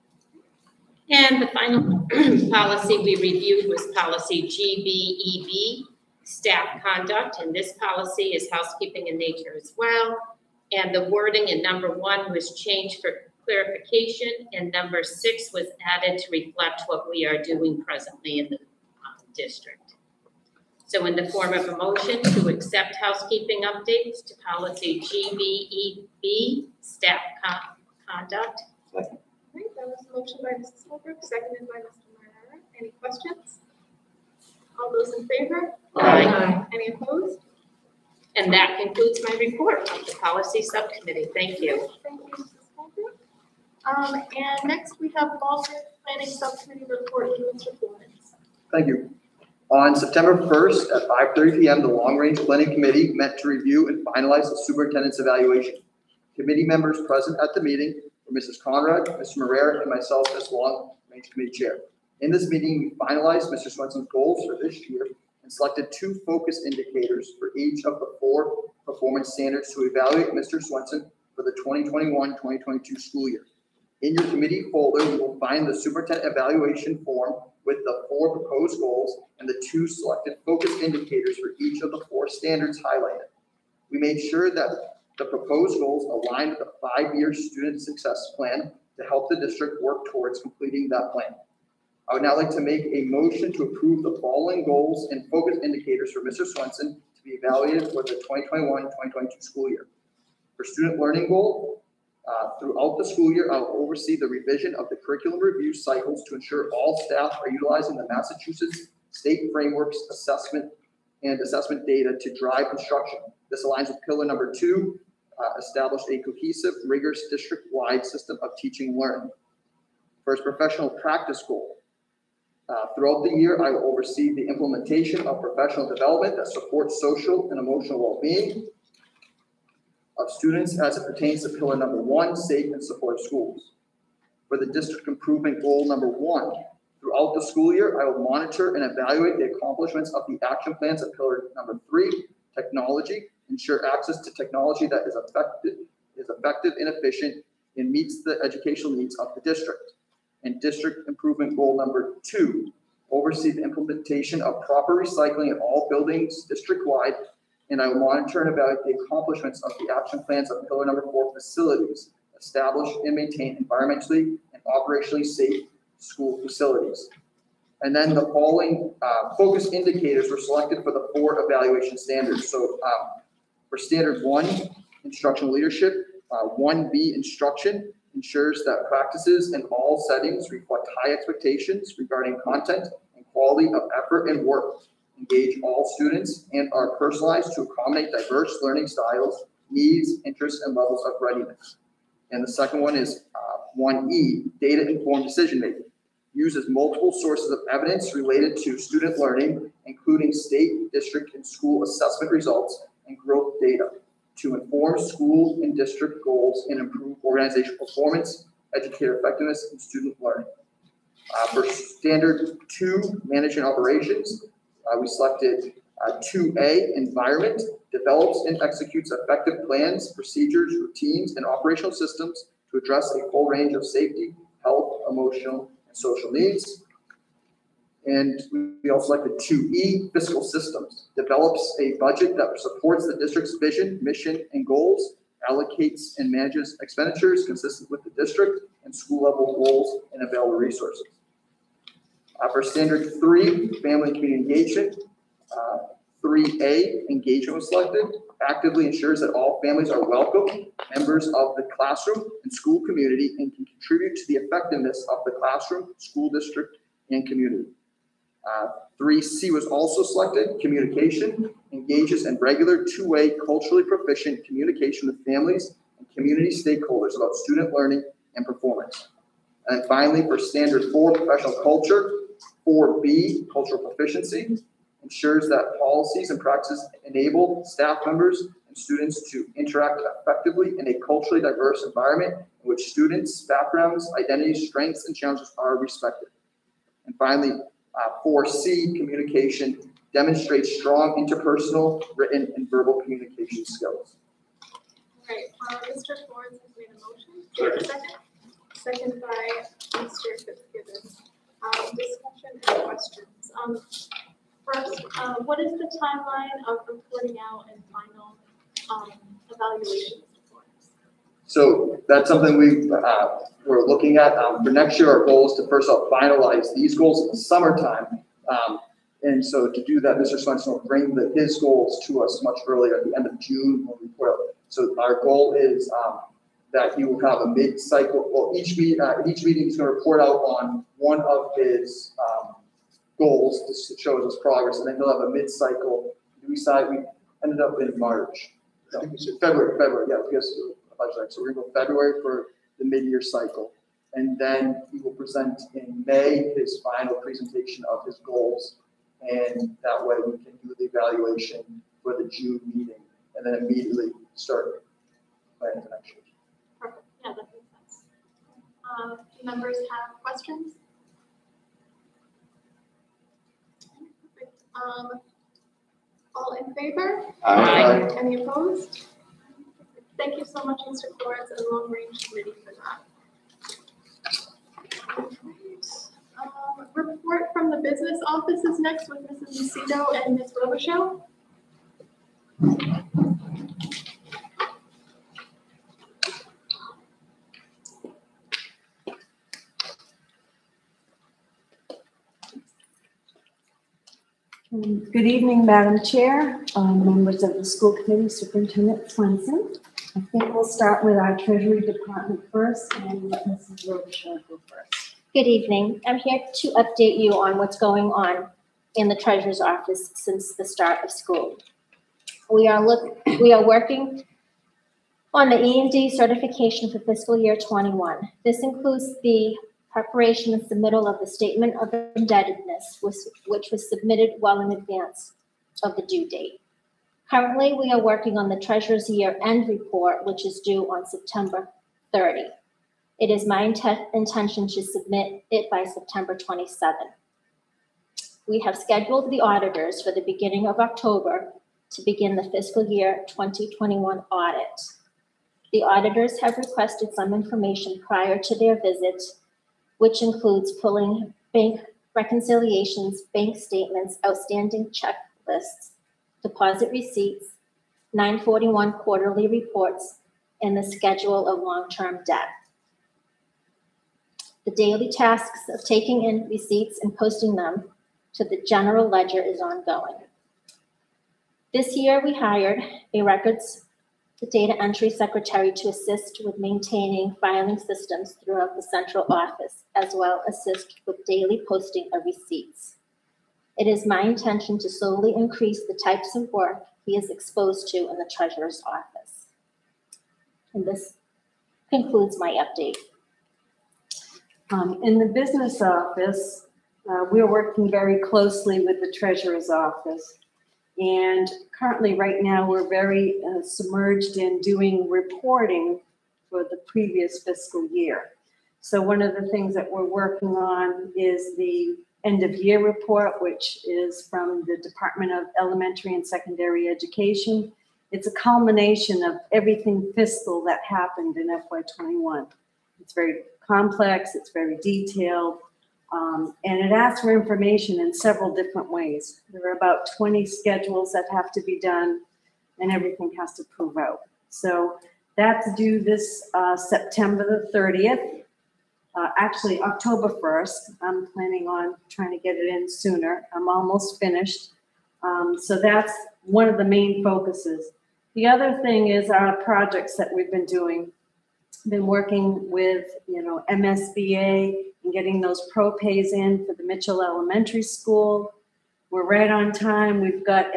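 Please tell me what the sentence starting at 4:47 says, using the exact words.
And finally, uh, 4C, communication, demonstrates strong interpersonal, written, and verbal communication skills.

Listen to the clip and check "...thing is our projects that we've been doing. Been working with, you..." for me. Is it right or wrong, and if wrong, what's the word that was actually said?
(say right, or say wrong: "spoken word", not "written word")
right.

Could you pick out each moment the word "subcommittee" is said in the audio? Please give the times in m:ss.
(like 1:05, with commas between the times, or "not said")
0:40, 0:46.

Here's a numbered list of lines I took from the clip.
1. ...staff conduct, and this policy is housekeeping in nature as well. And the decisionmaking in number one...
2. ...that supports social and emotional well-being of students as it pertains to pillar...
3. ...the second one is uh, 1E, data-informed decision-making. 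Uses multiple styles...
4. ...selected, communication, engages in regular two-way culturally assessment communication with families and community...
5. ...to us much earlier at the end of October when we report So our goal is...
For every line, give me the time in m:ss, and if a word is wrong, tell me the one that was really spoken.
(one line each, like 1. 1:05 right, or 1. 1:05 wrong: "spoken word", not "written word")
1. 0:06 wrong: "wording", not "decisionmaking"
2. 2:06 right
3. 3:12 wrong: "sources", not "styles"
4. 4:20 wrong: "proficient", not "assessment"
5. 5:22 wrong: "June", not "October".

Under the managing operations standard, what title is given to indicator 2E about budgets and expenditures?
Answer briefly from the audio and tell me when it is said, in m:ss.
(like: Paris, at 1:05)
fiscal systems, at 3:50.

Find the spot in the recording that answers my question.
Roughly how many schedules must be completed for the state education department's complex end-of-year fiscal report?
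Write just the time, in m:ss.
8:50.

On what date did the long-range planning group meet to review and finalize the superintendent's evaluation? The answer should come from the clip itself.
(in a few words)
September 1st.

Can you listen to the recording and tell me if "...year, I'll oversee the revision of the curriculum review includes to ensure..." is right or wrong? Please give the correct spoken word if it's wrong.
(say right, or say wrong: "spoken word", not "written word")
wrong: "cycles", not "includes".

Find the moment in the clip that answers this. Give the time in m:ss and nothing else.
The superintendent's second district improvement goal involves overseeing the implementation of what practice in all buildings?
2:34.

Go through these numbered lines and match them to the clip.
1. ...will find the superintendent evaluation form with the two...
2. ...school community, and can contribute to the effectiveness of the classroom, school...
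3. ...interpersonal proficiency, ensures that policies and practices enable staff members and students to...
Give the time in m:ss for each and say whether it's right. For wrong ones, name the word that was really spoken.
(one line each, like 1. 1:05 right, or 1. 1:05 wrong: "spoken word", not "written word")
1. 1:15 wrong: "four", not "two"
2. 4:12 right
3. 4:33 wrong: "cultural", not "interpersonal".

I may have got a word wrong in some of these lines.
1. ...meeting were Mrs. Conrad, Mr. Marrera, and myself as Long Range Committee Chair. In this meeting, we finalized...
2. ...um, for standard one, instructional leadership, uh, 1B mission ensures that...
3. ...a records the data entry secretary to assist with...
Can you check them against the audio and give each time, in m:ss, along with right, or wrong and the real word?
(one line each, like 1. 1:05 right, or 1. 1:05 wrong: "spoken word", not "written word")
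1. 0:57 right
2. 2:52 wrong: "instruction", not "mission"
3. 7:53 right.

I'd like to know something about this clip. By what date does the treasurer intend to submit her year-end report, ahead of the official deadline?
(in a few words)
September 27.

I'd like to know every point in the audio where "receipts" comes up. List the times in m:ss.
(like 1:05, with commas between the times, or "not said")
7:36, 7:46, 8:02.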